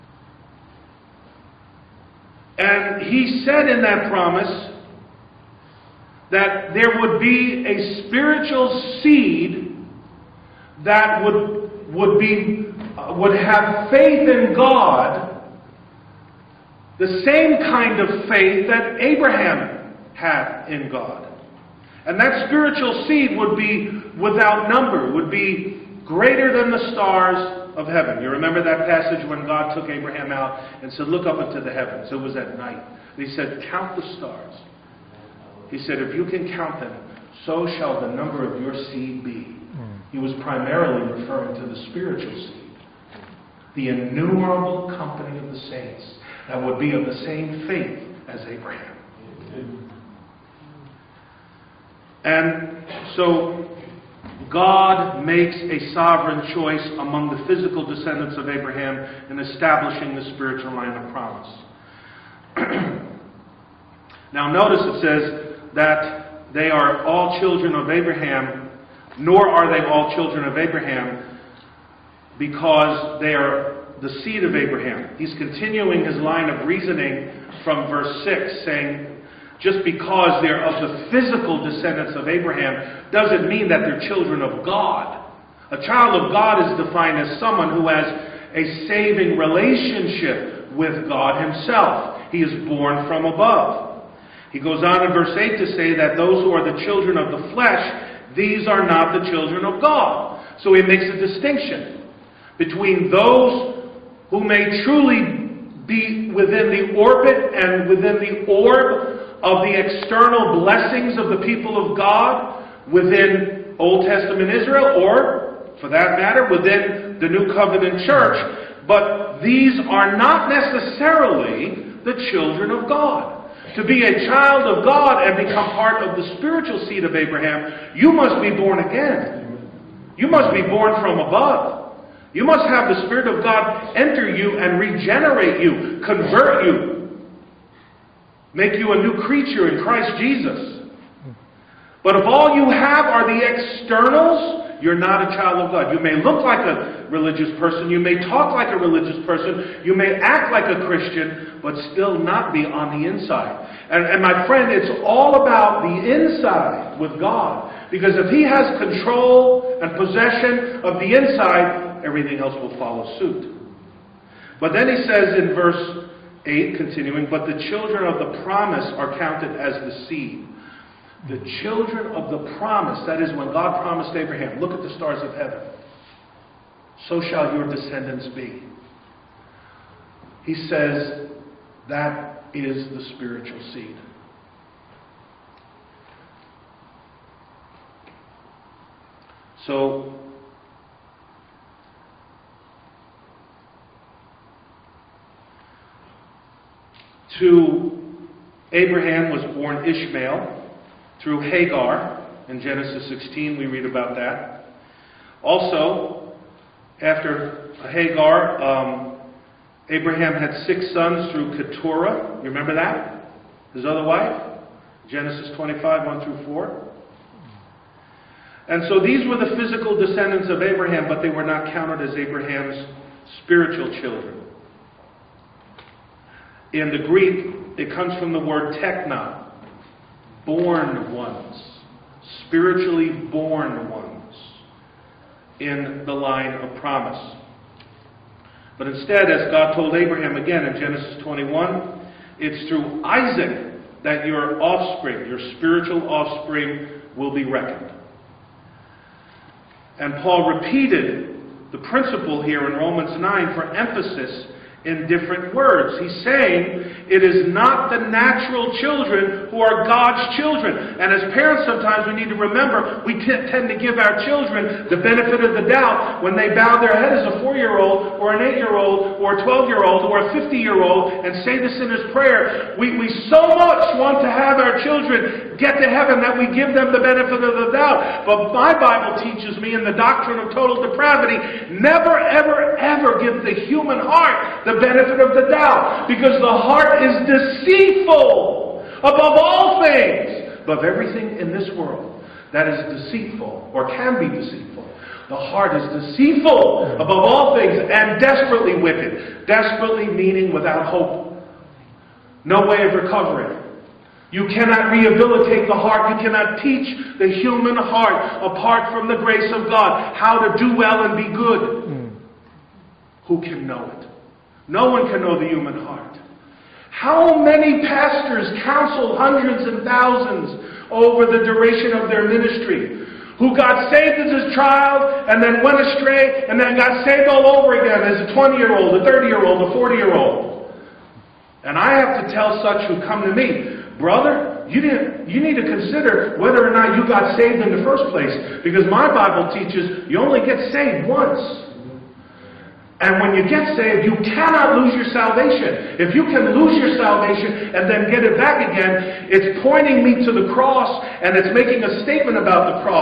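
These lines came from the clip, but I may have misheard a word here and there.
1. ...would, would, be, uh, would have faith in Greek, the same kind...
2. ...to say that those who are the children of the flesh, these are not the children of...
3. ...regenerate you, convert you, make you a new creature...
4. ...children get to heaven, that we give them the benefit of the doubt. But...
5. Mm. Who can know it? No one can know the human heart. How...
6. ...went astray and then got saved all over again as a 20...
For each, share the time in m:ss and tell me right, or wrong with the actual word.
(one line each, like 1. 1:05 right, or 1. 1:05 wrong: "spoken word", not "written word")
1. 0:11 wrong: "God", not "Greek"
2. 1:35 right
3. 2:14 right
4. 4:34 right
5. 5:11 right
6. 5:25 right.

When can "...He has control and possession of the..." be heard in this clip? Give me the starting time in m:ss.
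2:38.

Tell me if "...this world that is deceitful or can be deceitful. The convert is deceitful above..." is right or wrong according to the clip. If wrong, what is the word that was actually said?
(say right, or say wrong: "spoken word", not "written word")
wrong: "heart", not "convert".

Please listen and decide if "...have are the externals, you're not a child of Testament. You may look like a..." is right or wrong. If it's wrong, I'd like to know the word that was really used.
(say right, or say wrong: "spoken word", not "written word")
wrong: "God", not "Testament".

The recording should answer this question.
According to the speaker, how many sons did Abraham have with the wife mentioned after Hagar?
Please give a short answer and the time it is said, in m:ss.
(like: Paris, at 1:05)
6, at 3:30.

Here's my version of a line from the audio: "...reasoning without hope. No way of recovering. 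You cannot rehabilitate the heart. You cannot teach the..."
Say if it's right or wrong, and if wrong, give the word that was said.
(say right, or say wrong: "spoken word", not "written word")
wrong: "meaning", not "reasoning".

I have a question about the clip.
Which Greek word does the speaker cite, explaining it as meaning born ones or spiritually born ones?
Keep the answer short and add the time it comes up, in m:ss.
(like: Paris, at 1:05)
techna, at 3:48.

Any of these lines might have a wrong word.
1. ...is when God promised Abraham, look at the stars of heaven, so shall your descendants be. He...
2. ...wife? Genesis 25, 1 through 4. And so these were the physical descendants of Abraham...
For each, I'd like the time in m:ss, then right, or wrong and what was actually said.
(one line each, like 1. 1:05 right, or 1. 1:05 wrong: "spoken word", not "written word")
1. 2:53 right
2. 3:34 right.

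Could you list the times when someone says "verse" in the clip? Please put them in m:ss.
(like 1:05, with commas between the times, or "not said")
1:17, 1:35, 2:45.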